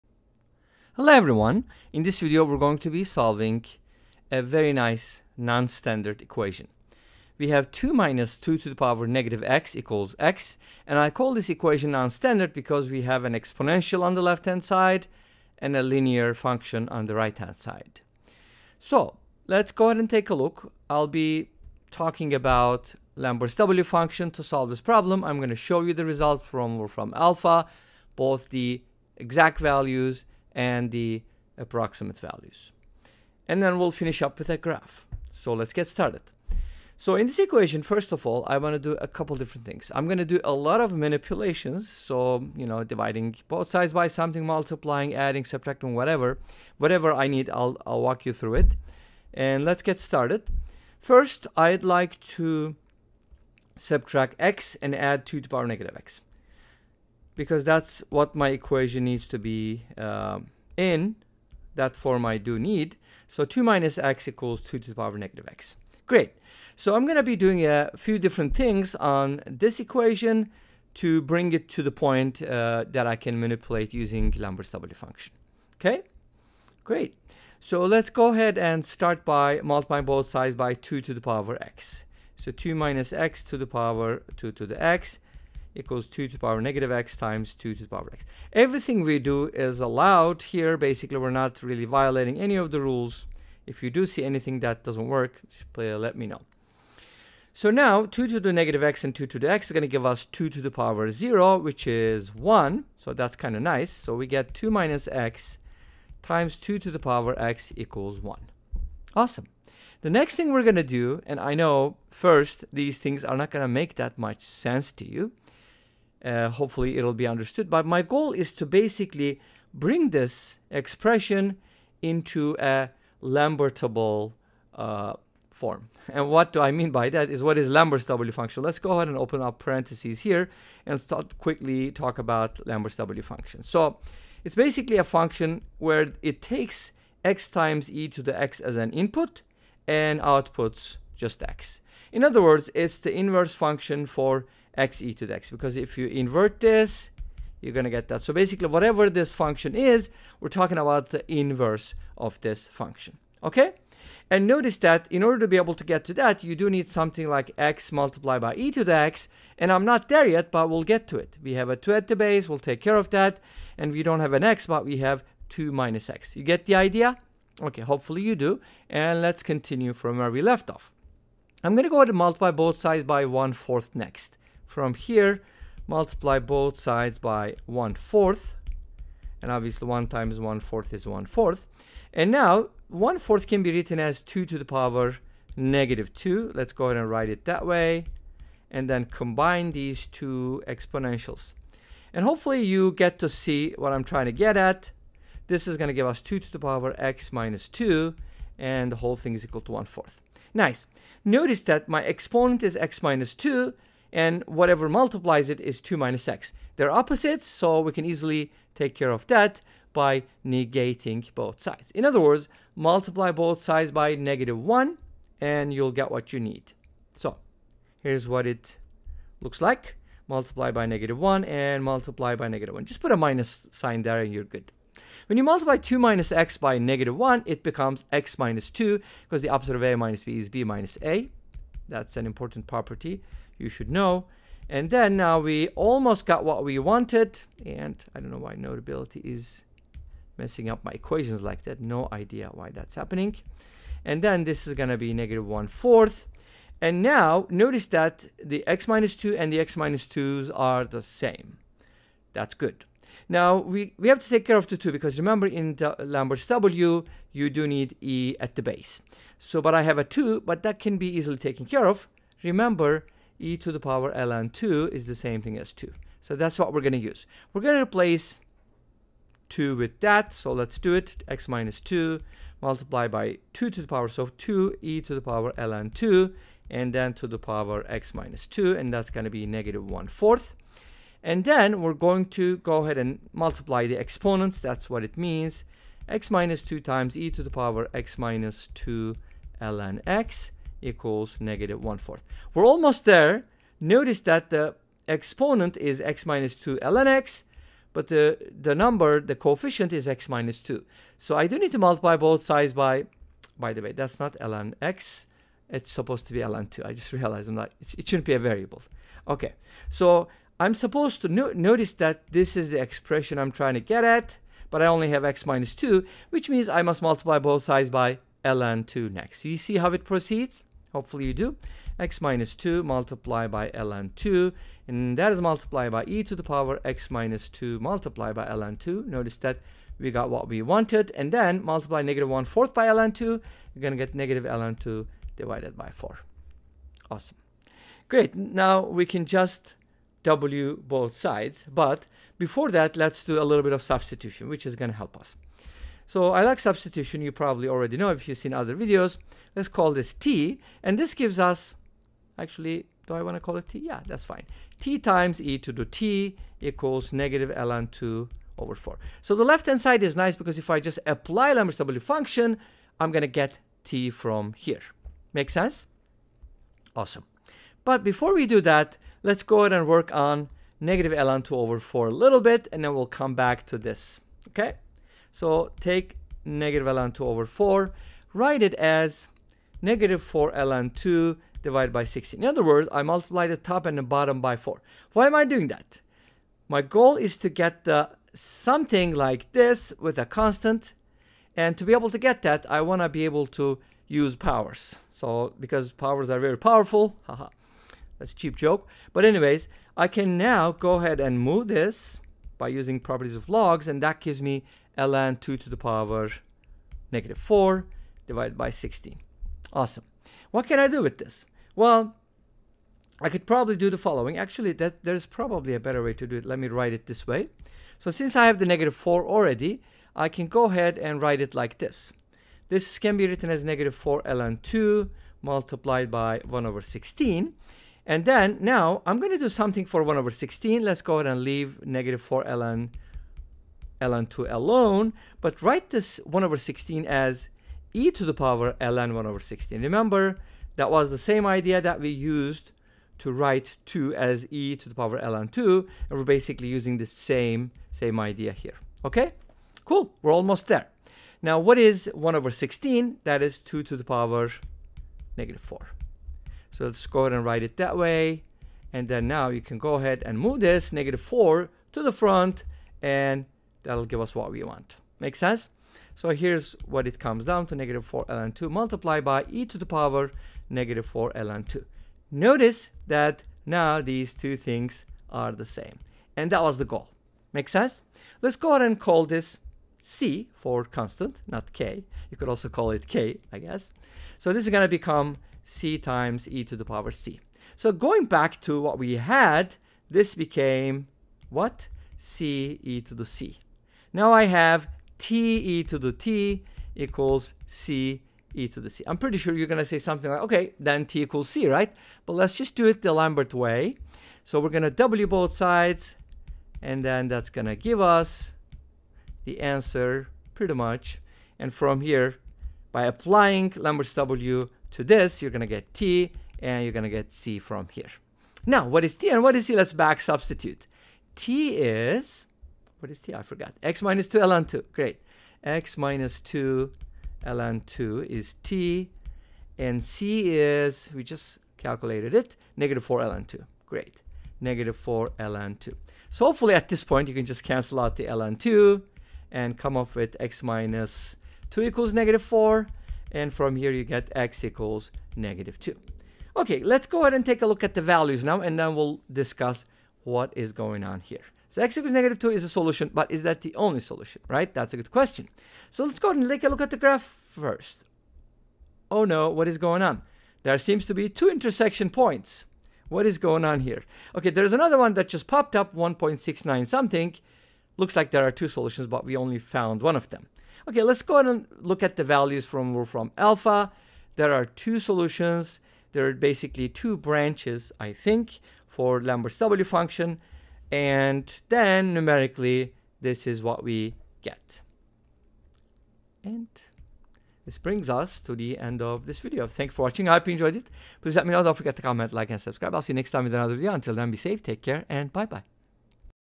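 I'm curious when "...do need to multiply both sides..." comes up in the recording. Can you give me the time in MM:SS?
05:01.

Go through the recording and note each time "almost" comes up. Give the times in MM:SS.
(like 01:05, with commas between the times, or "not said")
03:55, 04:52, 07:30.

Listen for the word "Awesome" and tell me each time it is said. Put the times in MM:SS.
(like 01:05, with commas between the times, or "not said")
01:49, 05:37, 06:06, 06:49.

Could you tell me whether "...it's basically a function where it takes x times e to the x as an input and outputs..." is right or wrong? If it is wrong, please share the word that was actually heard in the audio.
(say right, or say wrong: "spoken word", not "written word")
right.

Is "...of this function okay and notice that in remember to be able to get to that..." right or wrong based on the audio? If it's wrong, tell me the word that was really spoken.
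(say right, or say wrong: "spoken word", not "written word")
wrong: "order", not "remember".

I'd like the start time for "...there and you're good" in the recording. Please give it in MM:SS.
03:44.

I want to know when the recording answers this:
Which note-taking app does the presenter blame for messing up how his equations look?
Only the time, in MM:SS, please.
03:58.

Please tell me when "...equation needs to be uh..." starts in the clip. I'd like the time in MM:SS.
00:58.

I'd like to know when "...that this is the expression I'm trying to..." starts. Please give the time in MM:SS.
05:11.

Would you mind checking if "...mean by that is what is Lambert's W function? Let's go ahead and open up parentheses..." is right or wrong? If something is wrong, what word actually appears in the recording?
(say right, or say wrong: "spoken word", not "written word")
right.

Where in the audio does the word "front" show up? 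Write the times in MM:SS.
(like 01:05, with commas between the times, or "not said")
07:42.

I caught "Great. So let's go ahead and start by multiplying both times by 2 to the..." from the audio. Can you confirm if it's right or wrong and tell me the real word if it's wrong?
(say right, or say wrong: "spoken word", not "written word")
wrong: "sides", not "times".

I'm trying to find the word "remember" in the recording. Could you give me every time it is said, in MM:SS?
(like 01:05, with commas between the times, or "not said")
04:15, 04:22, 07:19.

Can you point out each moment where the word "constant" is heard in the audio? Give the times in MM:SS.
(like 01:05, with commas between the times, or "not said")
06:30, 08:00.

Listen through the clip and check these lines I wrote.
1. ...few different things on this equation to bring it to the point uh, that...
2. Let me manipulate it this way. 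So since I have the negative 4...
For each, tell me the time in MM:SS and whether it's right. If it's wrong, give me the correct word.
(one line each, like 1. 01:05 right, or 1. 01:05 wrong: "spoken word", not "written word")
1. 01:07 right
2. 06:56 wrong: "write", not "manipulate".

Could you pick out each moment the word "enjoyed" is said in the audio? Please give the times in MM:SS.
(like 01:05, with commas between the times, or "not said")
09:50.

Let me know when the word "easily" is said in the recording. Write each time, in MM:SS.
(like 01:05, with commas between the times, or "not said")
03:28, 04:21.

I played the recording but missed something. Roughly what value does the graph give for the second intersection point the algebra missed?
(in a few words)
1.69.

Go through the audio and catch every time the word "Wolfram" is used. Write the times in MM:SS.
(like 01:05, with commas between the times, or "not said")
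00:26, 09:32.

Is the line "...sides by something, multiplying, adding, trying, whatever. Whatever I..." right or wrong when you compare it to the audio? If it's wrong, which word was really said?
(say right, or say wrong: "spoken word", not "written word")
wrong: "subtracting", not "trying".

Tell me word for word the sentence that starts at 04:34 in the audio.
So 2 e to the power ln 2 and then to the power x minus 2.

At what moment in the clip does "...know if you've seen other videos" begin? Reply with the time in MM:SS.
05:47.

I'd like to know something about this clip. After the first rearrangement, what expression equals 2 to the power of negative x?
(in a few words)
2 minus x.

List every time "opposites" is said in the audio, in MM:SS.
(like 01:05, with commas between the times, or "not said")
03:26, 03:49.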